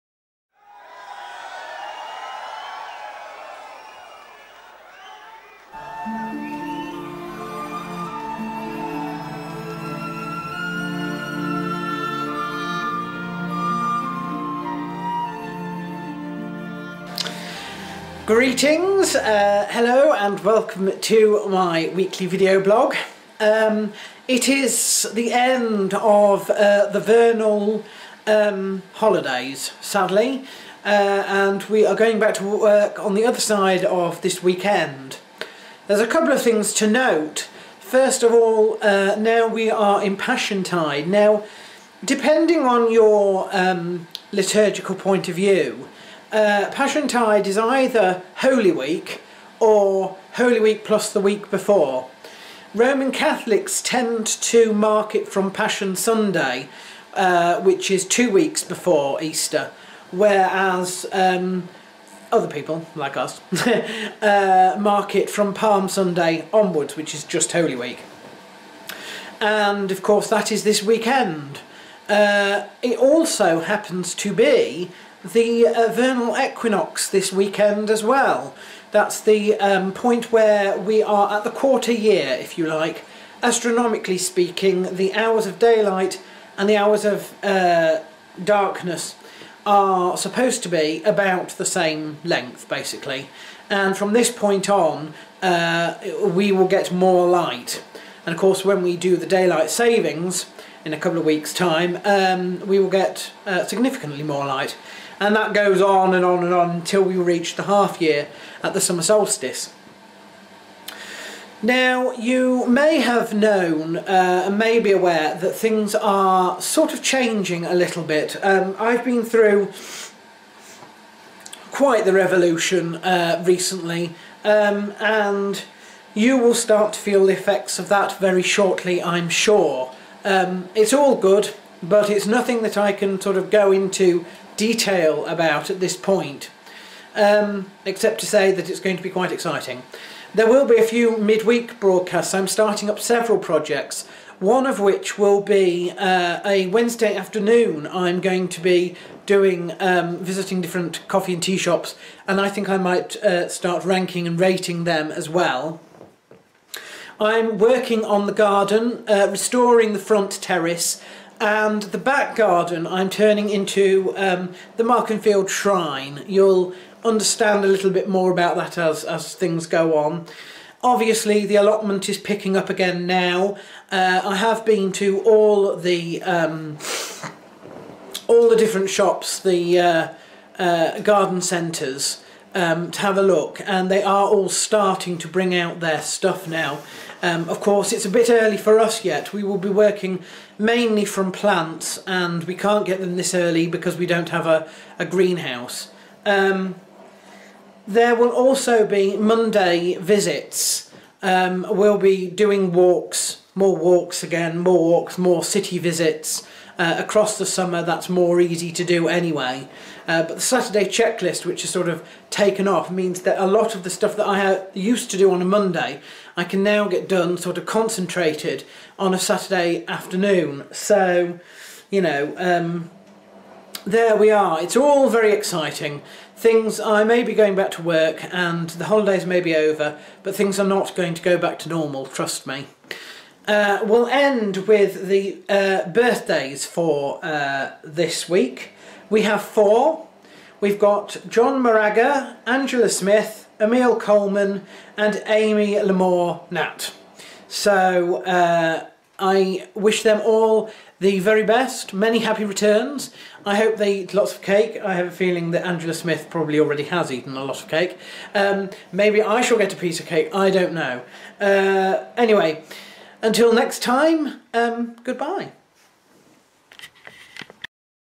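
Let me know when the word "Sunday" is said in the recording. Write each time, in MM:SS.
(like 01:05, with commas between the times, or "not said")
00:55, 01:05.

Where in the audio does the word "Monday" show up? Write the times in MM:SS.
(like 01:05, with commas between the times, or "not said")
03:19, 03:35.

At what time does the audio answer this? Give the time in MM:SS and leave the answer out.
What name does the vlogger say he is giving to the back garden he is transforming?
02:44.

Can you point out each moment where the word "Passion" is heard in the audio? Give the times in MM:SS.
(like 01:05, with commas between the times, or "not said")
00:40, 00:46, 00:55.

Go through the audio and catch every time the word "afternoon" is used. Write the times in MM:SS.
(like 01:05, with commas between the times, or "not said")
02:27, 03:39.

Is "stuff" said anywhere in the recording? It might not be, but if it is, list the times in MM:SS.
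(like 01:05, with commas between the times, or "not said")
03:06, 03:33.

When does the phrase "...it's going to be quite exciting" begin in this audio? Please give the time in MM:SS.
02:18.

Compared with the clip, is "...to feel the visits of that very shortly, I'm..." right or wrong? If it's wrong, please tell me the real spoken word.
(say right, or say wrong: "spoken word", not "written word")
wrong: "effects", not "visits".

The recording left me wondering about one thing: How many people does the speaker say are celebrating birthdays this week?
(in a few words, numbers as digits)
4.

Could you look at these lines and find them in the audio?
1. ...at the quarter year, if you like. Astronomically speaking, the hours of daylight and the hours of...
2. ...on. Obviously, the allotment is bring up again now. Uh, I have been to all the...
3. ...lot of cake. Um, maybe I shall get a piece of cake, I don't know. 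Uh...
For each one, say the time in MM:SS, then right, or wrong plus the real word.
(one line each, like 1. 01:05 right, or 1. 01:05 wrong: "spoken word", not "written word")
1. 01:21 right
2. 02:49 wrong: "picking", not "bring"
3. 04:17 right.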